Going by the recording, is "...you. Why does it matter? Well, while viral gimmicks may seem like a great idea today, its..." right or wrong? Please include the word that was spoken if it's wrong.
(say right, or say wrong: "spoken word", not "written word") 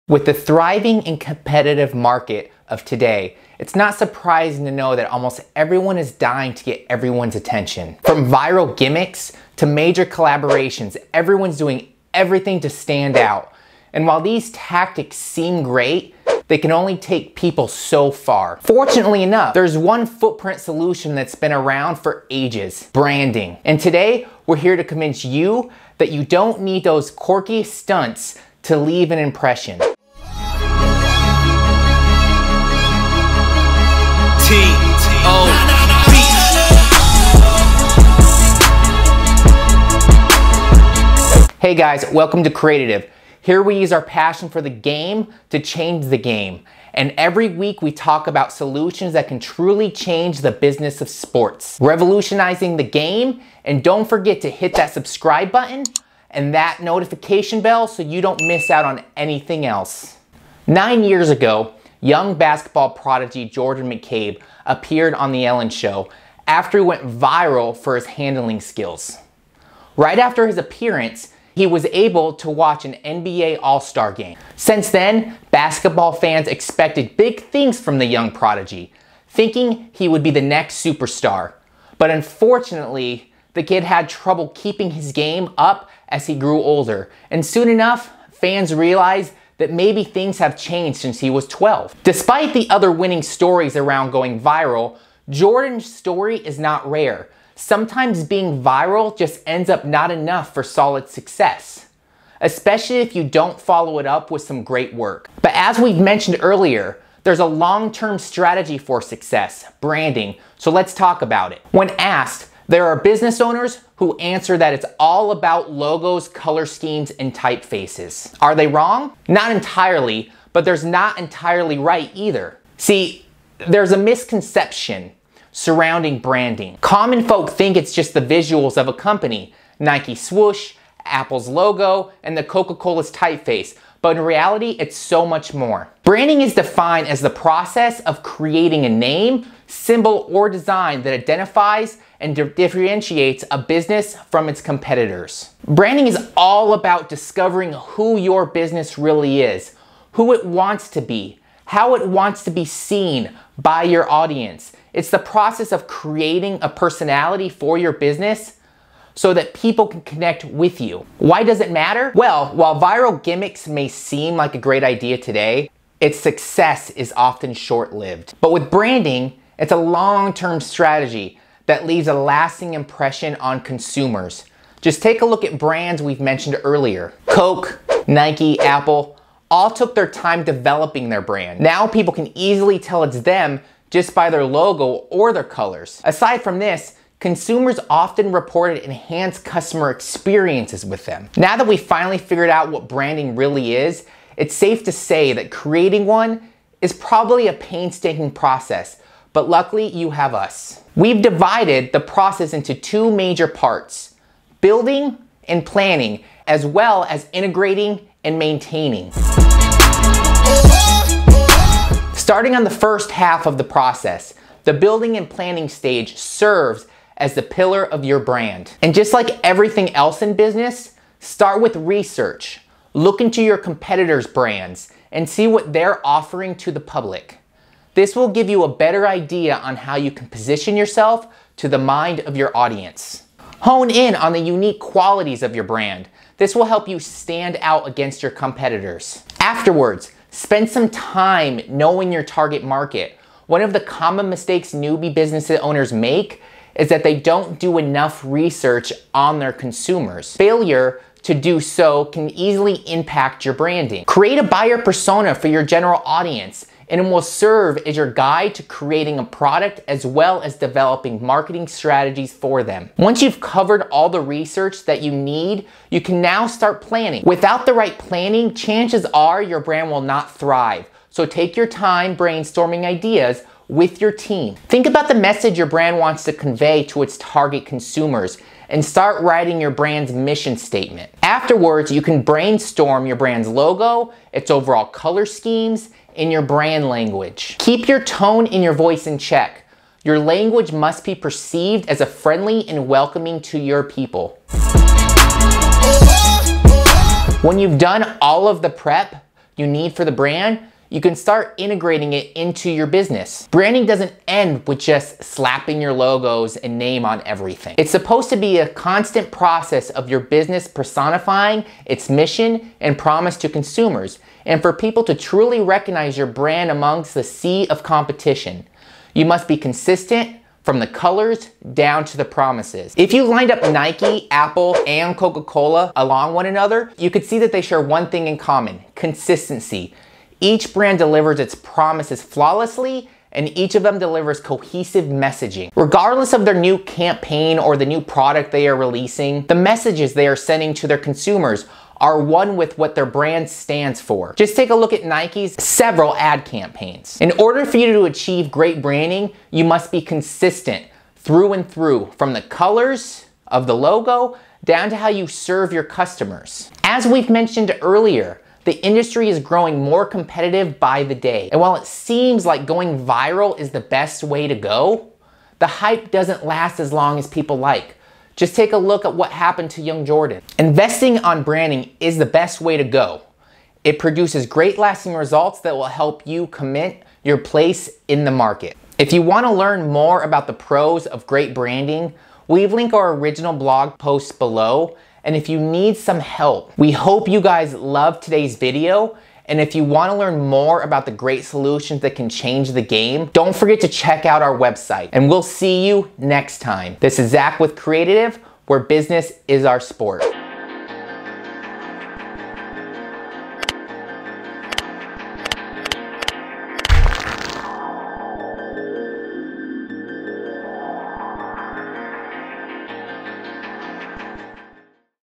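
right.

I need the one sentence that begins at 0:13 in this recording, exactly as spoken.
And while these tactics seem great, they can only take people so far.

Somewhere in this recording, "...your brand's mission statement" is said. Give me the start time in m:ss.
4:39.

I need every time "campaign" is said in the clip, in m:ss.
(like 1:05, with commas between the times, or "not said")
5:36, 5:46.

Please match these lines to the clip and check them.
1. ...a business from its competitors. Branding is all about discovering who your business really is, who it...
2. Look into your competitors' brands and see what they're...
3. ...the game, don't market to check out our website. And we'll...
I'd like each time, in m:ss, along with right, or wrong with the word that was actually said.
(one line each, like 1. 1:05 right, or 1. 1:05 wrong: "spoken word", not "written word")
1. 2:23 right
2. 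3:42 right
3. 6:32 wrong: "forget", not "market".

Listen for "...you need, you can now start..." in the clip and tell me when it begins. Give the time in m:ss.
4:25.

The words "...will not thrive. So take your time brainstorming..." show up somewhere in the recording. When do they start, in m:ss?
4:29.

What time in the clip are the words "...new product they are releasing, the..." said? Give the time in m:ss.
5:37.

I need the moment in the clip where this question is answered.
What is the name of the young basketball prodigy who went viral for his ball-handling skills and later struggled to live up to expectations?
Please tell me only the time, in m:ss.
1:03.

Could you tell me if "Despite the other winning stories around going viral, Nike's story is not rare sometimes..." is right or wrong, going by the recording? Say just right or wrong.
wrong.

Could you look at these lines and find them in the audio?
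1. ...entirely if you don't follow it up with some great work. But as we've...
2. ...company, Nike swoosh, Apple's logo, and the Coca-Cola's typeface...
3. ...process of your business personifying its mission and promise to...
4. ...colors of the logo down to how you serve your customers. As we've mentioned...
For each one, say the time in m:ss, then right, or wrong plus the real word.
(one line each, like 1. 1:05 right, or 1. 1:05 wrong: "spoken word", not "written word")
1. 1:42 wrong: "especially", not "entirely"
2. 2:08 right
3. 5:09 right
4. 5:52 right.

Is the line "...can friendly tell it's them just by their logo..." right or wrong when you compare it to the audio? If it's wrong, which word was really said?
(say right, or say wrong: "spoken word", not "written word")
wrong: "easily", not "friendly".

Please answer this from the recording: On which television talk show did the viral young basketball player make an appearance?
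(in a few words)
The Ellen Show.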